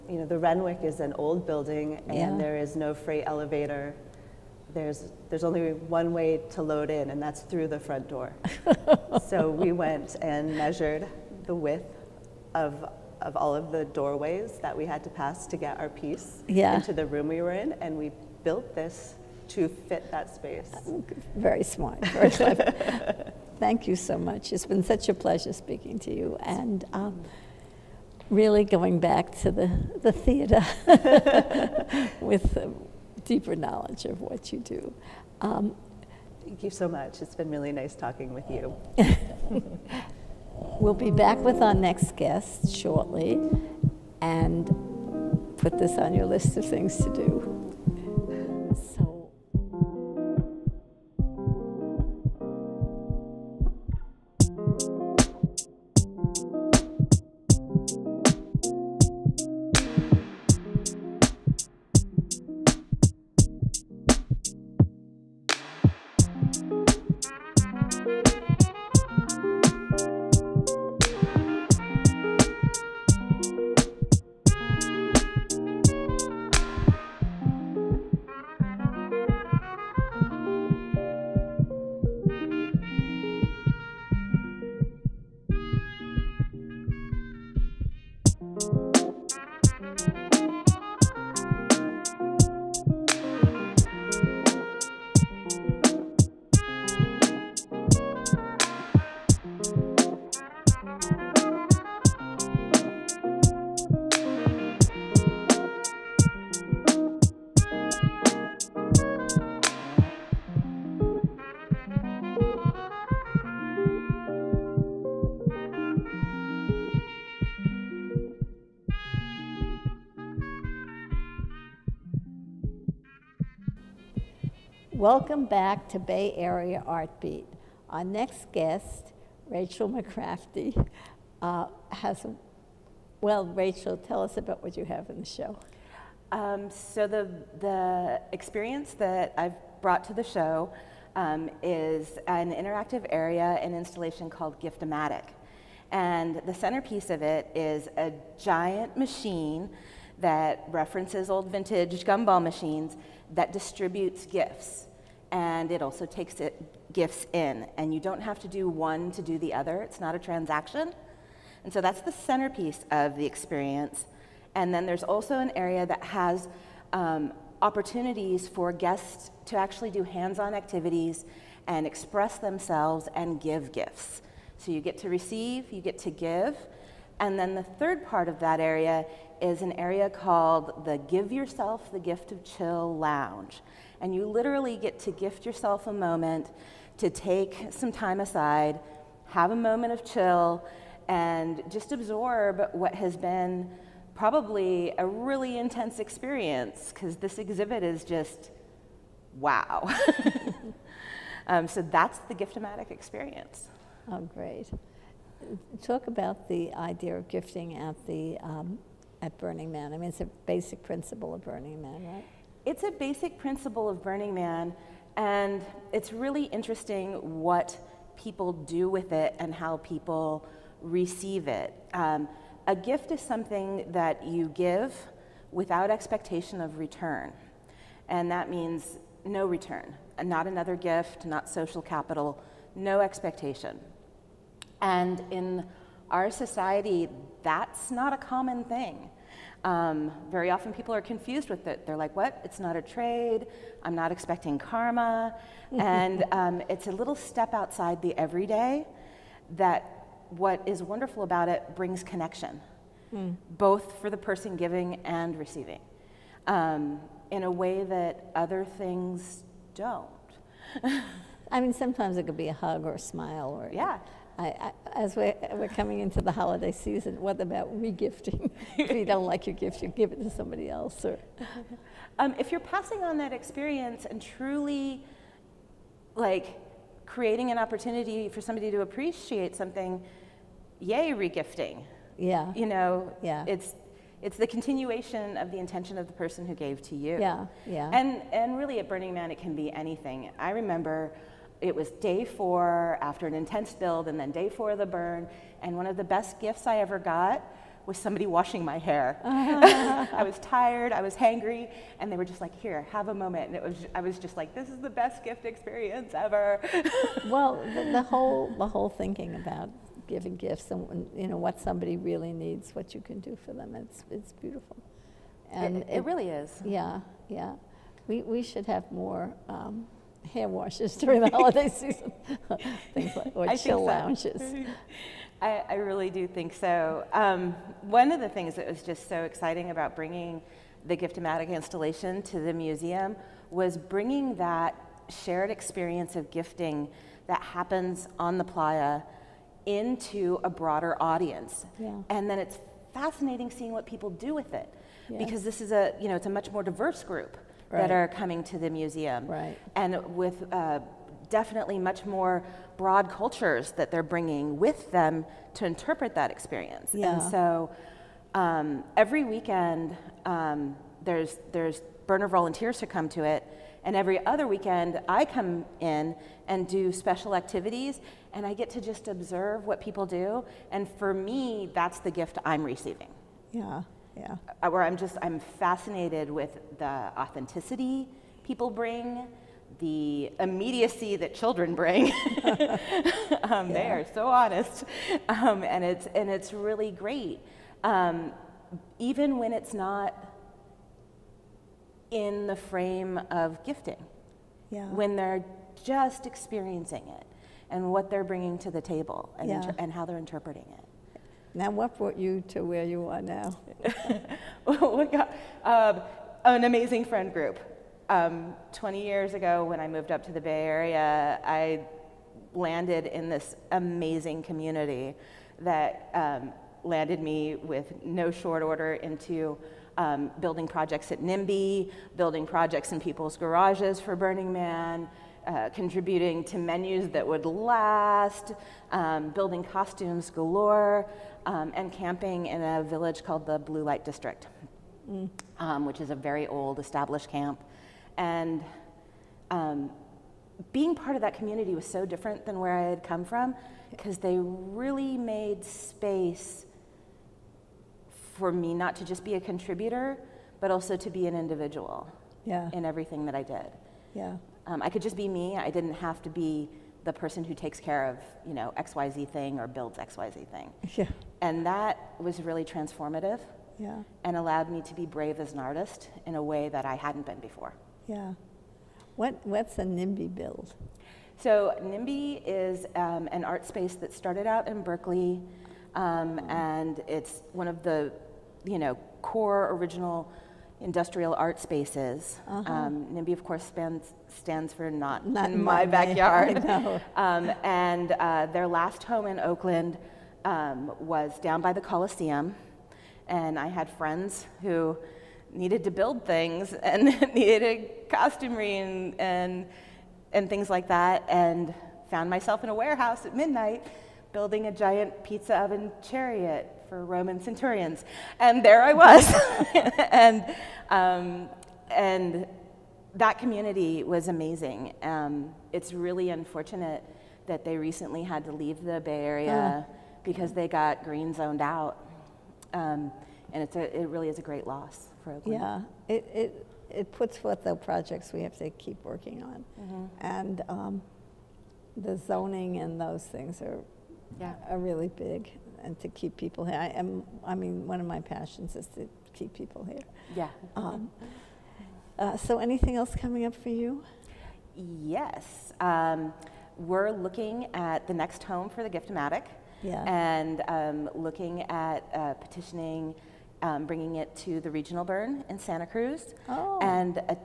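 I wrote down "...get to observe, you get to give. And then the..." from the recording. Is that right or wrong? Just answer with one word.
wrong.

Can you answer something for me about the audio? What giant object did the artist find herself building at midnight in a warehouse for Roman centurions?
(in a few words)
Pizza oven chariot.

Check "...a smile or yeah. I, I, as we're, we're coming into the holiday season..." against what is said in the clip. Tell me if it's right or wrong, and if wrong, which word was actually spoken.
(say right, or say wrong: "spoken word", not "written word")
right.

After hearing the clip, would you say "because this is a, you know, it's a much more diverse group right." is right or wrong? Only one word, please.
right.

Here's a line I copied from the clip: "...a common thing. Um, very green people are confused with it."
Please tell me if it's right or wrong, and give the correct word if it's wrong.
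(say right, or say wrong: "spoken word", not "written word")
wrong: "often", not "green".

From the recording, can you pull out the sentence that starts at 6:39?
inter- and how they're interpreting it.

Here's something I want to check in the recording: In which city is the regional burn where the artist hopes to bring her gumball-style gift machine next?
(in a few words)
Santa Cruz.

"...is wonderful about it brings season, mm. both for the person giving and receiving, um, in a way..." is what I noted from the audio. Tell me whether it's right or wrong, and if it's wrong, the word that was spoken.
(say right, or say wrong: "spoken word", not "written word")
wrong: "connection", not "season".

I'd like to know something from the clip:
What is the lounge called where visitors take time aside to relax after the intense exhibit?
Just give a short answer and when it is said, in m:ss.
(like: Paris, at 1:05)
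Give Yourself the Gift of Chill Lounge, at 3:00.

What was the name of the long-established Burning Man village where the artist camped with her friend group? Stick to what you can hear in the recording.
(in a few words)
Blue Light District.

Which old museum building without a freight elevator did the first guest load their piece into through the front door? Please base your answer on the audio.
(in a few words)
Renwick.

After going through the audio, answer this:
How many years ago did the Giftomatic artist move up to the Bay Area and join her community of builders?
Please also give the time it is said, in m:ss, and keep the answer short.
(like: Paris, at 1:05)
20, at 6:48.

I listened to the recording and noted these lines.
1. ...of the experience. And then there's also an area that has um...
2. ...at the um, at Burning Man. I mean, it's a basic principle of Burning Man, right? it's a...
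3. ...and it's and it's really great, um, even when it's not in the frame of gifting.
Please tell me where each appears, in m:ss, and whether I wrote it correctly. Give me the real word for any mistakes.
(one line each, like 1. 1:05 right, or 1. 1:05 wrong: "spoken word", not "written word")
1. 2:42 right
2. 3:27 right
3. 6:25 right.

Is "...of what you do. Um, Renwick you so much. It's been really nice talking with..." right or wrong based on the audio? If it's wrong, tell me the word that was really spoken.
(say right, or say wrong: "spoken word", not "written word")
wrong: "Thank", not "Renwick".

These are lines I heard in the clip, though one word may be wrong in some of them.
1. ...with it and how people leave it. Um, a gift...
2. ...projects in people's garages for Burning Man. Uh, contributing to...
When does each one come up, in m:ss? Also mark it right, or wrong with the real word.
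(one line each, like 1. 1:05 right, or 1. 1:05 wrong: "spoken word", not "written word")
1. 3:38 wrong: "receive", not "leave"
2. 7:02 right.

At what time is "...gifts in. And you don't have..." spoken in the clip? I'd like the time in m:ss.
2:36.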